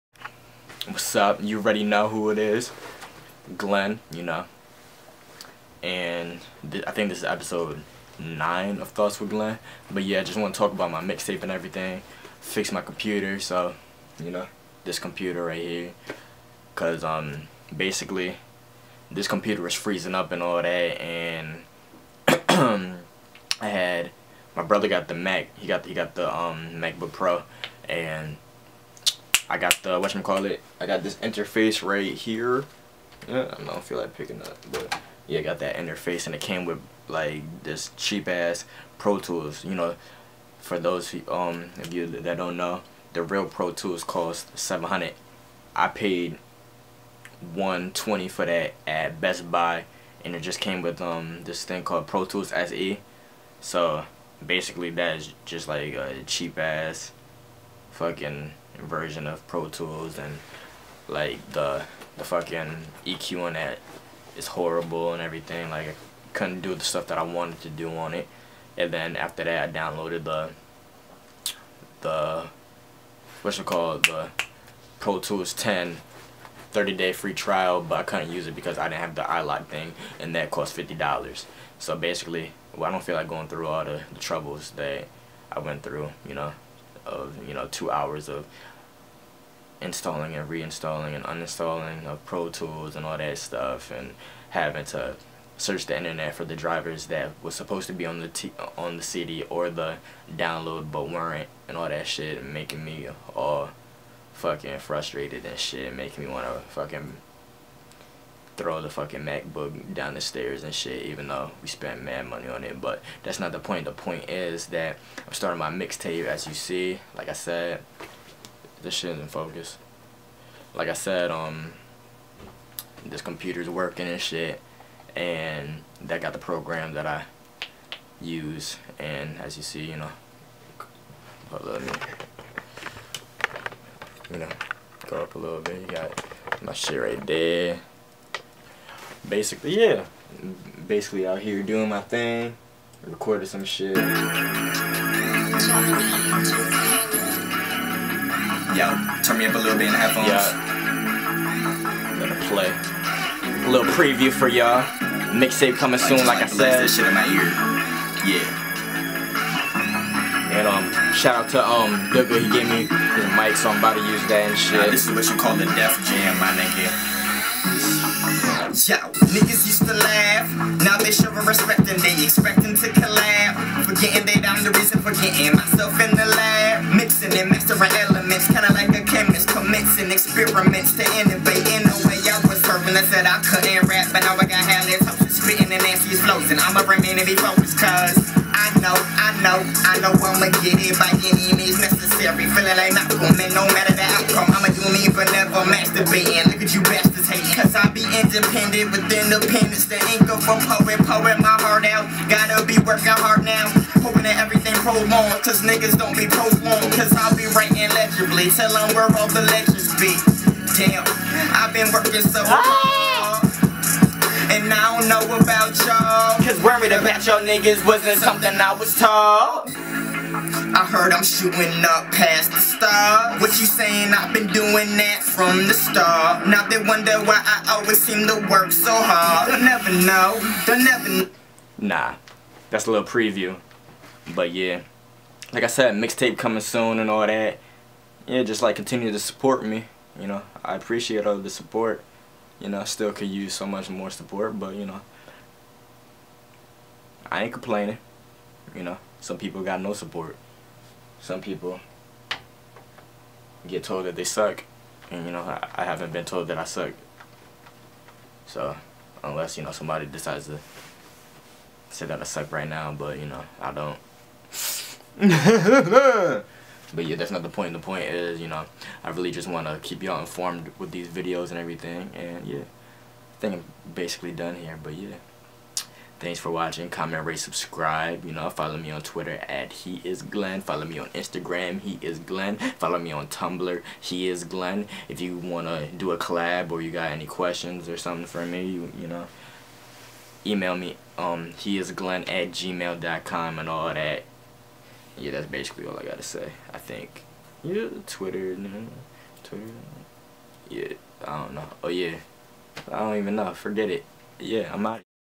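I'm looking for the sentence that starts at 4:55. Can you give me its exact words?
Yeah, that's basically all I got to say, I think.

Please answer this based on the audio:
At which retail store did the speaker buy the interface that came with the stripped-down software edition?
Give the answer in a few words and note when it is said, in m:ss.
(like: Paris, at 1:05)
Best Buy, at 0:49.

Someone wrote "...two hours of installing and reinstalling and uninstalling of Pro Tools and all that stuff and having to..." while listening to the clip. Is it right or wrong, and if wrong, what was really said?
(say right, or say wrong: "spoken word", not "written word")
right.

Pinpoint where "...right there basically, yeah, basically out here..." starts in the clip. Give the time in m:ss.
2:17.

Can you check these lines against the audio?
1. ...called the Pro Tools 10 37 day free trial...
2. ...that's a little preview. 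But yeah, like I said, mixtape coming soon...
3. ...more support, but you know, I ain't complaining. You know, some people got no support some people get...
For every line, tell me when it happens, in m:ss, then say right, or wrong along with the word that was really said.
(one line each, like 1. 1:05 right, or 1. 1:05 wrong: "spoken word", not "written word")
1. 1:13 wrong: "30", not "37"
2. 3:52 right
3. 4:03 right.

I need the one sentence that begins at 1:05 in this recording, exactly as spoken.
Like I couldn't do the stuff that I wanted to do on it.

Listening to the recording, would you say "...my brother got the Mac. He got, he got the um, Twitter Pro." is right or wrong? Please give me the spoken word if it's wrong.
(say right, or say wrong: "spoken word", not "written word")
wrong: "MacBook", not "Twitter".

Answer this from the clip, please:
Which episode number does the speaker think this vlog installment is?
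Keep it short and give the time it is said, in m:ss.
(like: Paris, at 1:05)
9, at 0:07.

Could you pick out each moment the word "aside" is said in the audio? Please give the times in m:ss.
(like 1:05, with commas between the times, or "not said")
not said.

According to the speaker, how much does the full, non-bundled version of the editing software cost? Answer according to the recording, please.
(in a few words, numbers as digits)
700.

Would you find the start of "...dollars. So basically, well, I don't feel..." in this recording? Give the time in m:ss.
1:20.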